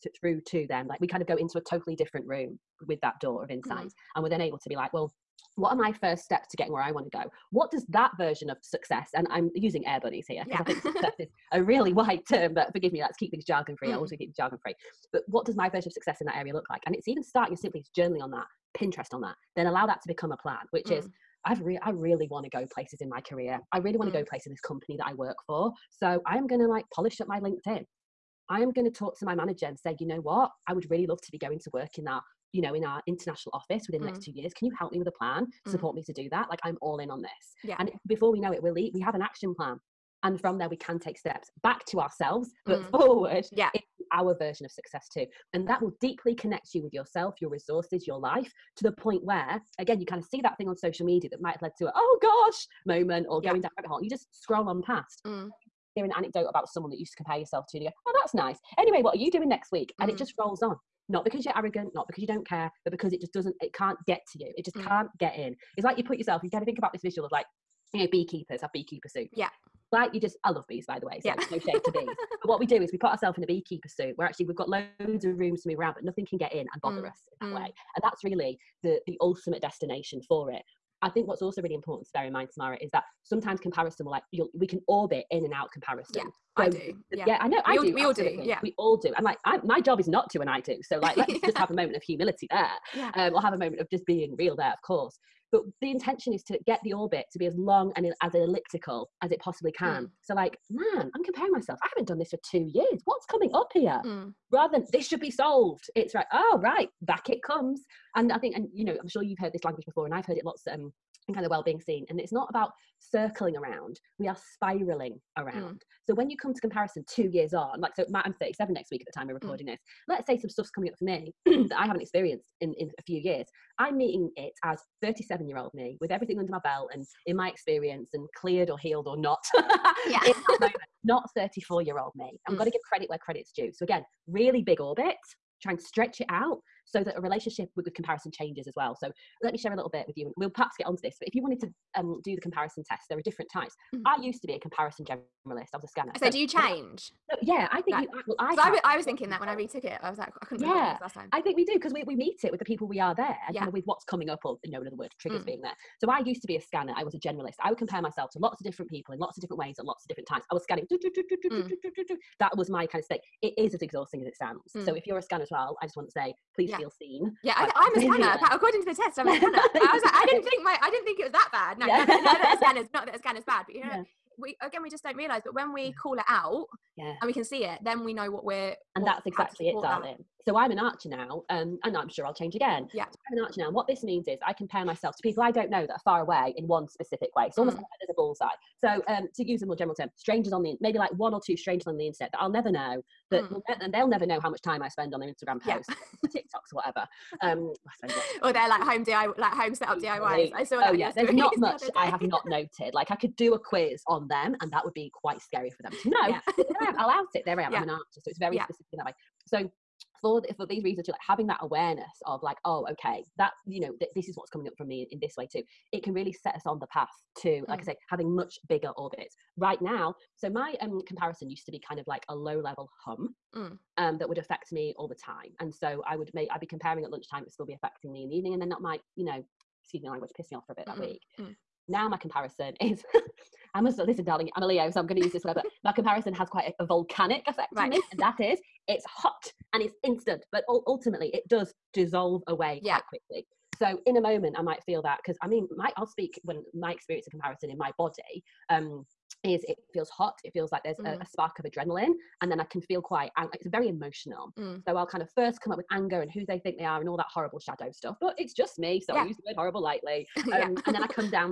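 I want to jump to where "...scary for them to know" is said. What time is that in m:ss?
3:25.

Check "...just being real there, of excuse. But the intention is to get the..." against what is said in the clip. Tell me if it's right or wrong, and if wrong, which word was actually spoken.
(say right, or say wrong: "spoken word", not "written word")
wrong: "course", not "excuse".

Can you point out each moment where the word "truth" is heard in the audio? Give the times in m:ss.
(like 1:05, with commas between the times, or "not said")
not said.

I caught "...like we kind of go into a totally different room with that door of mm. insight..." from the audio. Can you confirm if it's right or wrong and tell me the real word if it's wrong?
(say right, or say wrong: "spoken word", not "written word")
right.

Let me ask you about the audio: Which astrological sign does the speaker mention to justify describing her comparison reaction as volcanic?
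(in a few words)
Leo.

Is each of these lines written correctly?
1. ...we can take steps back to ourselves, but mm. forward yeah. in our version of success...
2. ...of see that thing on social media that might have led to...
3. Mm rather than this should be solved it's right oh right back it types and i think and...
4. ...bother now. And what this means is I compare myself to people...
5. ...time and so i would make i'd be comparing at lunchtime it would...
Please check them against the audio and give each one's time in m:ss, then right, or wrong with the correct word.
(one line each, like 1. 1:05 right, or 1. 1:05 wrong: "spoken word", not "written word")
1. 0:40 right
2. 0:50 right
3. 1:44 wrong: "comes", not "types"
4. 3:03 wrong: "archer", not "bother"
5. 3:45 right.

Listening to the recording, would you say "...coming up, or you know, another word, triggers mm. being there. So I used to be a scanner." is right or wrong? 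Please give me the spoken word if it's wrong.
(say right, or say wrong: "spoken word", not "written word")
right.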